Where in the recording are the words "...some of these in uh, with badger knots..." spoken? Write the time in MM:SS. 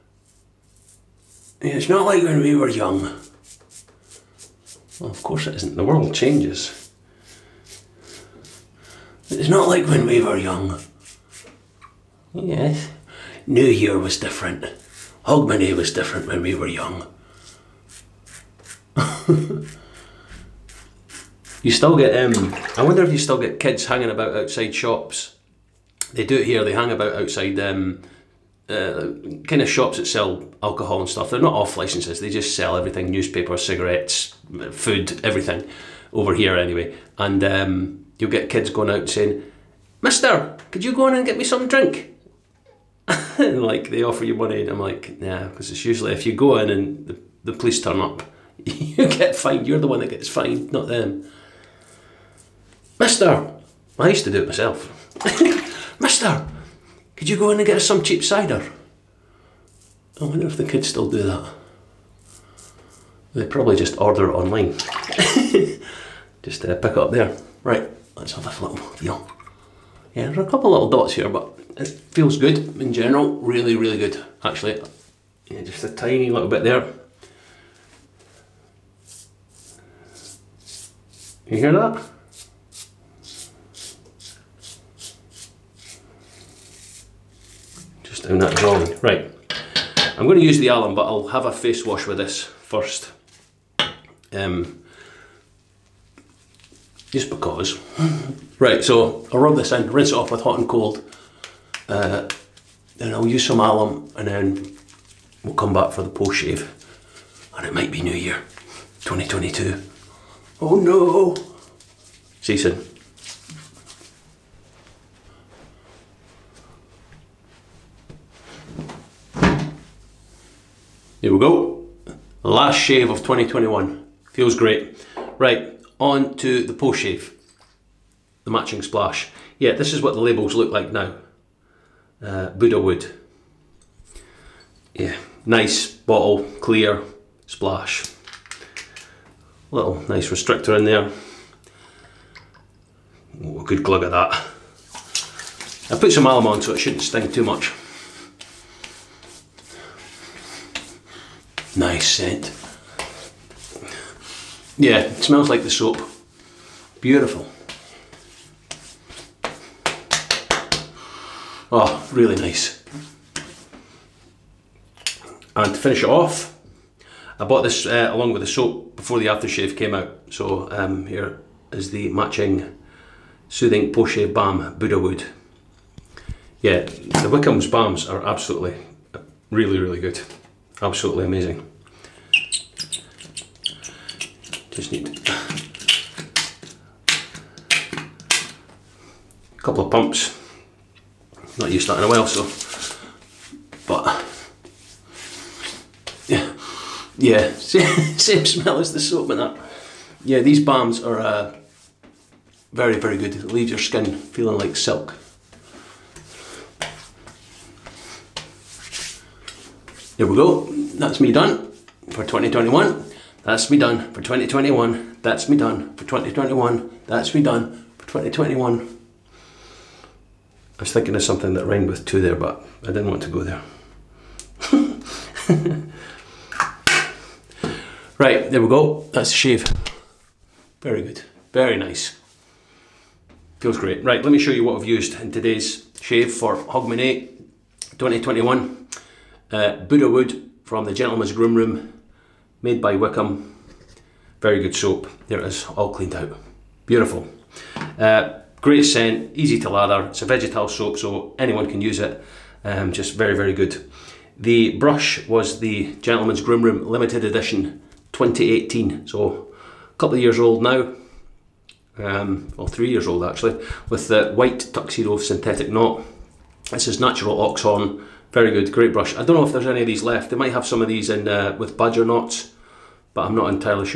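04:30.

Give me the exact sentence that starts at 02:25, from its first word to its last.
I put some alum on so it shouldn't sting too much.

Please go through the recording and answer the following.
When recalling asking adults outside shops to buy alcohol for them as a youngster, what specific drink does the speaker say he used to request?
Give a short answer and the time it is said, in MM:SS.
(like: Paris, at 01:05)
cheap cider, at 00:58.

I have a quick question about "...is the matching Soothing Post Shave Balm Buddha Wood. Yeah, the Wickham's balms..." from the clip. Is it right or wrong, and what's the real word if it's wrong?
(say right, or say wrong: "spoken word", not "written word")
right.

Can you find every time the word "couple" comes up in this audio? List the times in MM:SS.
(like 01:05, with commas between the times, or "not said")
01:10, 03:09, 04:19.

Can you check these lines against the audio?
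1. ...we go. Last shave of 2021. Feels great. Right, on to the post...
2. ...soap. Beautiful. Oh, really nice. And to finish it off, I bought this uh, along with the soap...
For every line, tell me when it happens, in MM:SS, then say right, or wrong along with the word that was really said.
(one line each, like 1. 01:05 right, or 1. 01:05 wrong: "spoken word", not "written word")
1. 02:01 right
2. 02:35 right.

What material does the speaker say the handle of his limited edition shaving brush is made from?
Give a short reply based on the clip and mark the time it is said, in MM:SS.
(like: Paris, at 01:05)
natural ox horn, at 04:27.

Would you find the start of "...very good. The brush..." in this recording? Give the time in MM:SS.
04:13.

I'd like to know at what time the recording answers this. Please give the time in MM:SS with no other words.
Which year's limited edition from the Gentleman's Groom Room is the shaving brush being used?
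04:18.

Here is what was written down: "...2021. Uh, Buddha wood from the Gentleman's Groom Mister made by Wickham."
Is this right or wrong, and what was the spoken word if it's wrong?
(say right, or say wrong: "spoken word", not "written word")
wrong: "Room", not "Mister".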